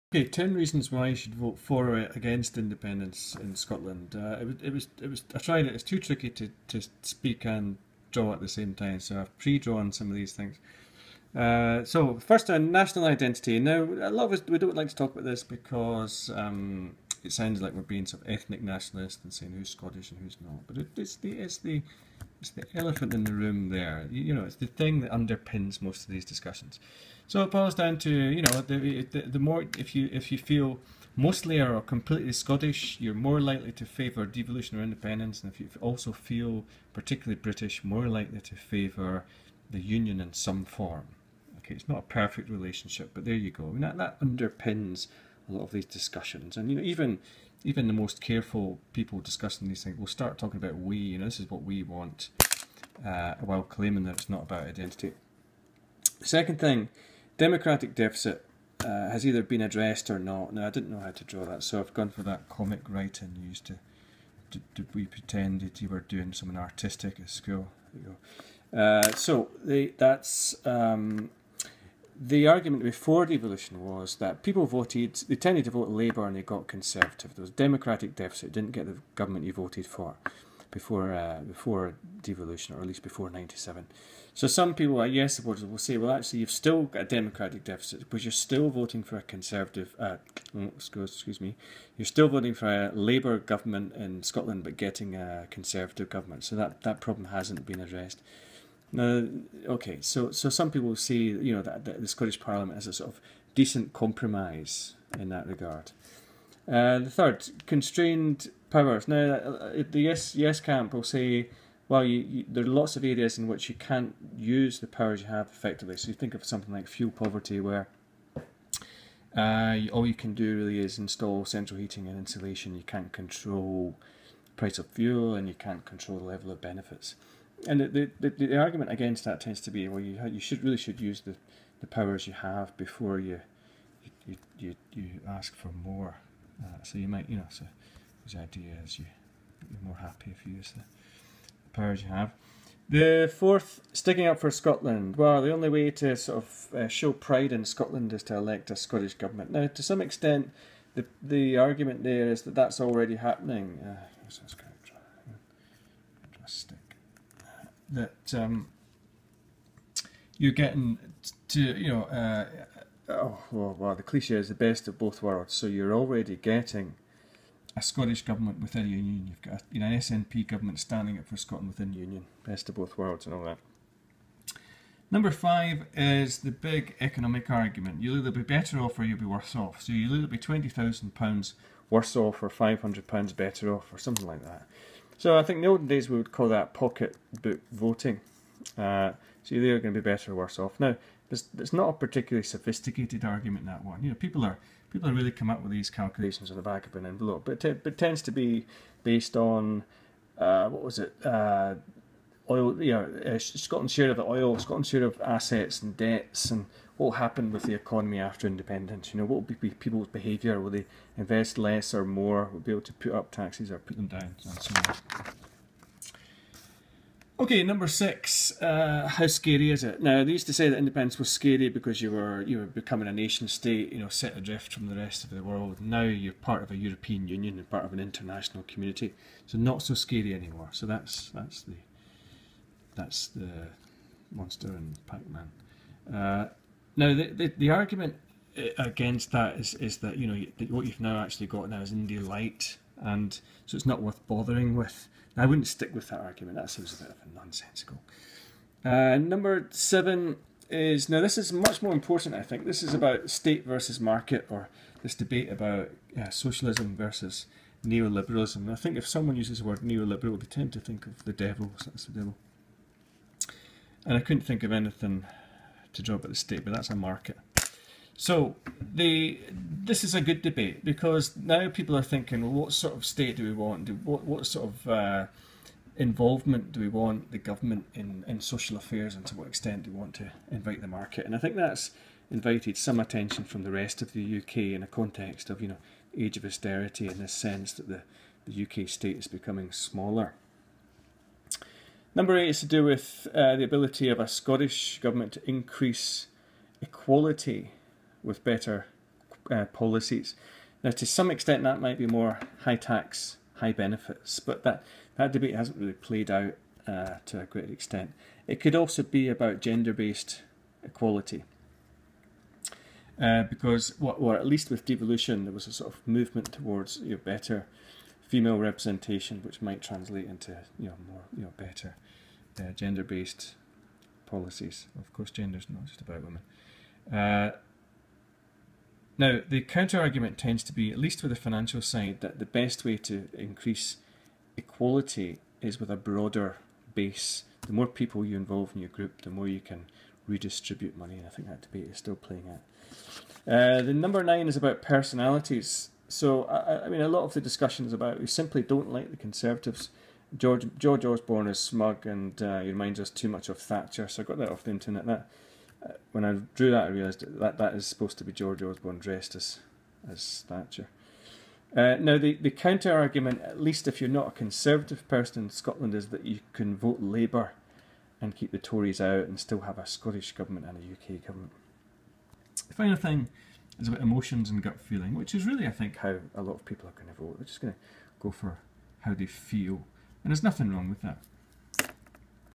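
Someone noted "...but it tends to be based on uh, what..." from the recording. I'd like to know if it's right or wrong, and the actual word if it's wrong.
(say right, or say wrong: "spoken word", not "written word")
right.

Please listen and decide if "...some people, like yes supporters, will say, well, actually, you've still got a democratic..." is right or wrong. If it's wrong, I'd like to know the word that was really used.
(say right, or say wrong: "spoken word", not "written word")
right.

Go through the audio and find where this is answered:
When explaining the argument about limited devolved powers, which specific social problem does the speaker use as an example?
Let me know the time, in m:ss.
1:56.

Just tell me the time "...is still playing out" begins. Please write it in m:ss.
5:41.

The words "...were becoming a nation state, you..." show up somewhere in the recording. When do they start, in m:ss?
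3:42.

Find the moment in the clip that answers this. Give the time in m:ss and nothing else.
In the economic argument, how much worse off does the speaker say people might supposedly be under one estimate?
3:00.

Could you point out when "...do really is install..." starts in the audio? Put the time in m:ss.
2:00.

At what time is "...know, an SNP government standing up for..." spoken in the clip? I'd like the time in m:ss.
2:49.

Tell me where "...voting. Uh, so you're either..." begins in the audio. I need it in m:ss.
3:07.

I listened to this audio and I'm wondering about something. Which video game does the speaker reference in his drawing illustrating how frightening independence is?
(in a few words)
Pac-Man.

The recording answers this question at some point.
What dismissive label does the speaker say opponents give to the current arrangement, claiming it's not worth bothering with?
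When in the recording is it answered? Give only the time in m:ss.
4:01.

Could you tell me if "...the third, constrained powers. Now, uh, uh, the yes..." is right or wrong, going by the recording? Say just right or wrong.
right.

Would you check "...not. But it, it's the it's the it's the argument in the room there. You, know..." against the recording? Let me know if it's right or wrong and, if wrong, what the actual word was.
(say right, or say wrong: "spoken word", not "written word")
wrong: "elephant", not "argument".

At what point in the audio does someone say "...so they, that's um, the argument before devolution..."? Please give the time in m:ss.
1:09.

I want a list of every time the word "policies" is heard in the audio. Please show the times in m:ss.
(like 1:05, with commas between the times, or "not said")
4:59, 5:24.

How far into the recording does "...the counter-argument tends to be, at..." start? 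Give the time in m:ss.
5:29.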